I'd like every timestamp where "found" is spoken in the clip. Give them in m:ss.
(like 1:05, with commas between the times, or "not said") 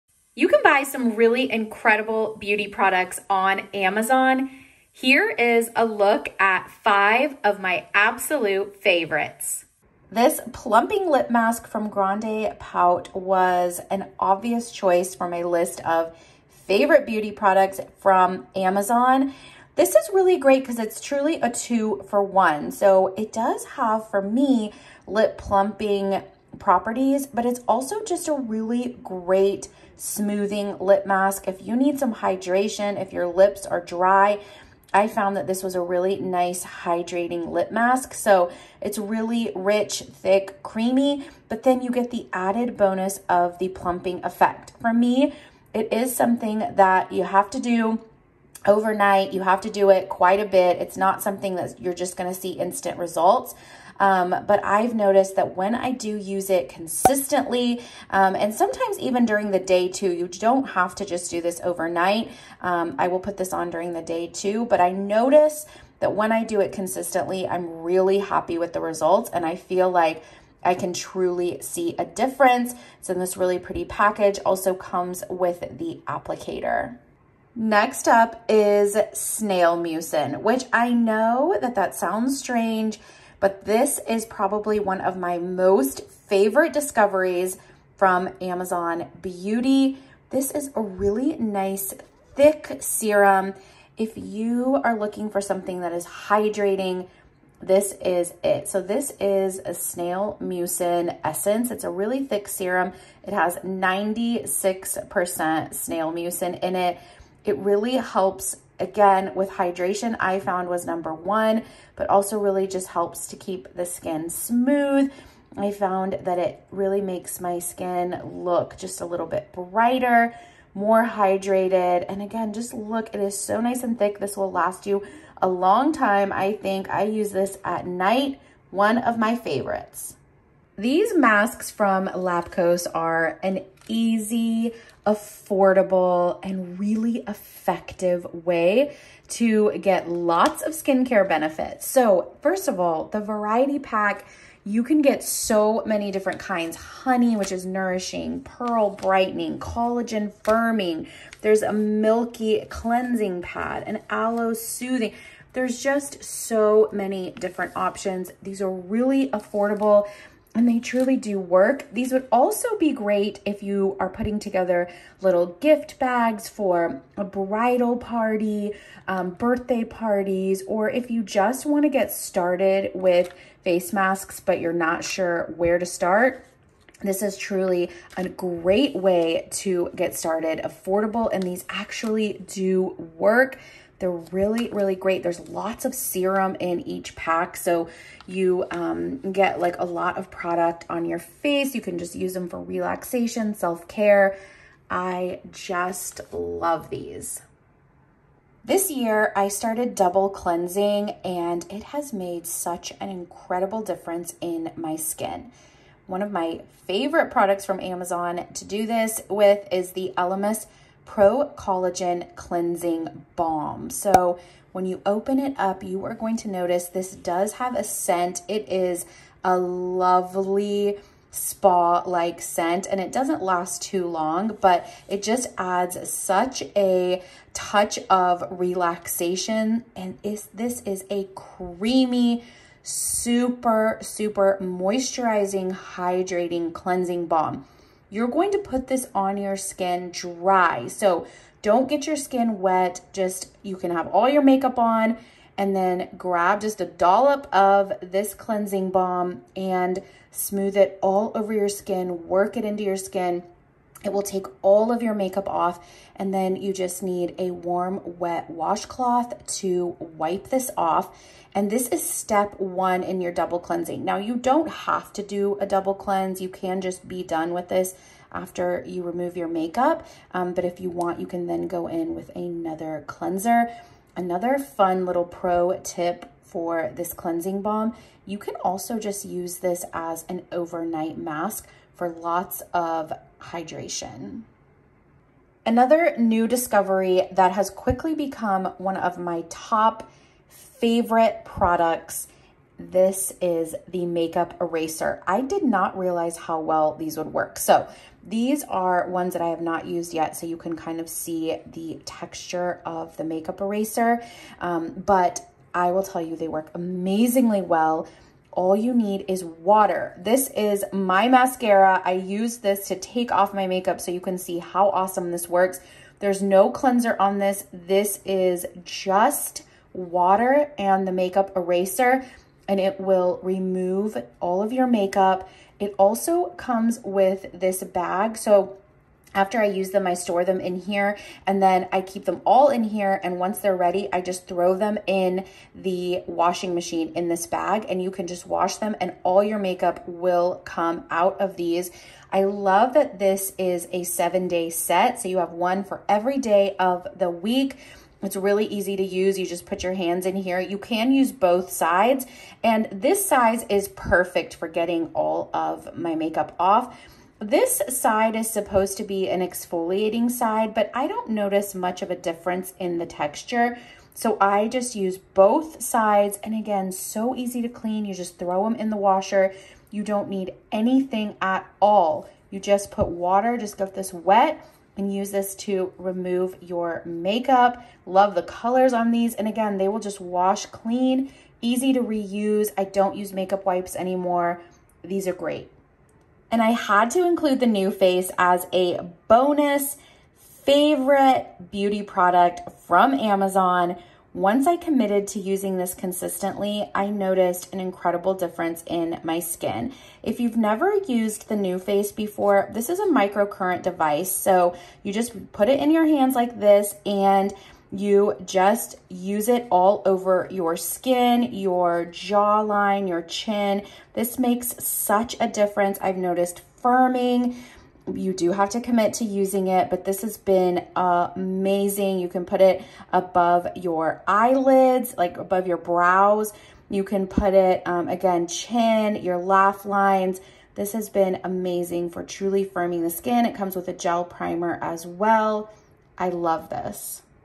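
0:35, 1:50, 1:55.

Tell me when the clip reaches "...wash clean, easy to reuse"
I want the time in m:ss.
6:20.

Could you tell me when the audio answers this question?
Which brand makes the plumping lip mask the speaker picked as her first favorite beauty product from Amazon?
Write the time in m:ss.
0:11.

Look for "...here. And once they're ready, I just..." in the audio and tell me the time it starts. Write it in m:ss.
5:32.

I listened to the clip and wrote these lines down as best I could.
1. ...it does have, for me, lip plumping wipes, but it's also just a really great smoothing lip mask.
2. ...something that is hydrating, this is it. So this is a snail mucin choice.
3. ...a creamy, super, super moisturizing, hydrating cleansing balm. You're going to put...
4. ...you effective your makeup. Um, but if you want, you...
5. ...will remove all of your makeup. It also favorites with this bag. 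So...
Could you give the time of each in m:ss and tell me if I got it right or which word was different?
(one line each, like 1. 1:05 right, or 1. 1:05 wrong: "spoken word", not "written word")
1. 0:23 wrong: "properties", not "wipes"
2. 1:35 wrong: "essence", not "choice"
3. 3:51 right
4. 4:28 wrong: "remove", not "effective"
5. 5:22 wrong: "comes", not "favorites".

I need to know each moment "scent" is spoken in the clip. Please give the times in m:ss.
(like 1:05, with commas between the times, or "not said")
3:37, 3:42.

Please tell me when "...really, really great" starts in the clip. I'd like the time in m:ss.
3:04.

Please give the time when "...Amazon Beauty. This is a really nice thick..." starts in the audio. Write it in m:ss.
1:28.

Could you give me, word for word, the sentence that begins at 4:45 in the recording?
Another new discovery that has quickly become one of my top favorite products this is the makeup eraser.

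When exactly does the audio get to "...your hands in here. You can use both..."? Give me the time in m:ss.
5:49.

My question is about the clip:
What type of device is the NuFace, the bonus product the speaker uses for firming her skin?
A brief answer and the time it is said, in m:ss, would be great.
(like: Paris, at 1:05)
Microcurrent device, at 6:43.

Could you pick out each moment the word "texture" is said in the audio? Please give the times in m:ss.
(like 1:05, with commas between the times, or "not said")
5:02, 6:03.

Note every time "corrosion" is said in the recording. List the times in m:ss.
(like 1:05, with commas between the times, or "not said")
not said.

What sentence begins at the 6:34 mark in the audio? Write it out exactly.
Once I committed to using this consistently, I noticed an incredible difference in my skin.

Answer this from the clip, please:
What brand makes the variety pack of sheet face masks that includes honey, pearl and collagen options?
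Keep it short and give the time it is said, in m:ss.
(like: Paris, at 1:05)
Lapcos, at 2:12.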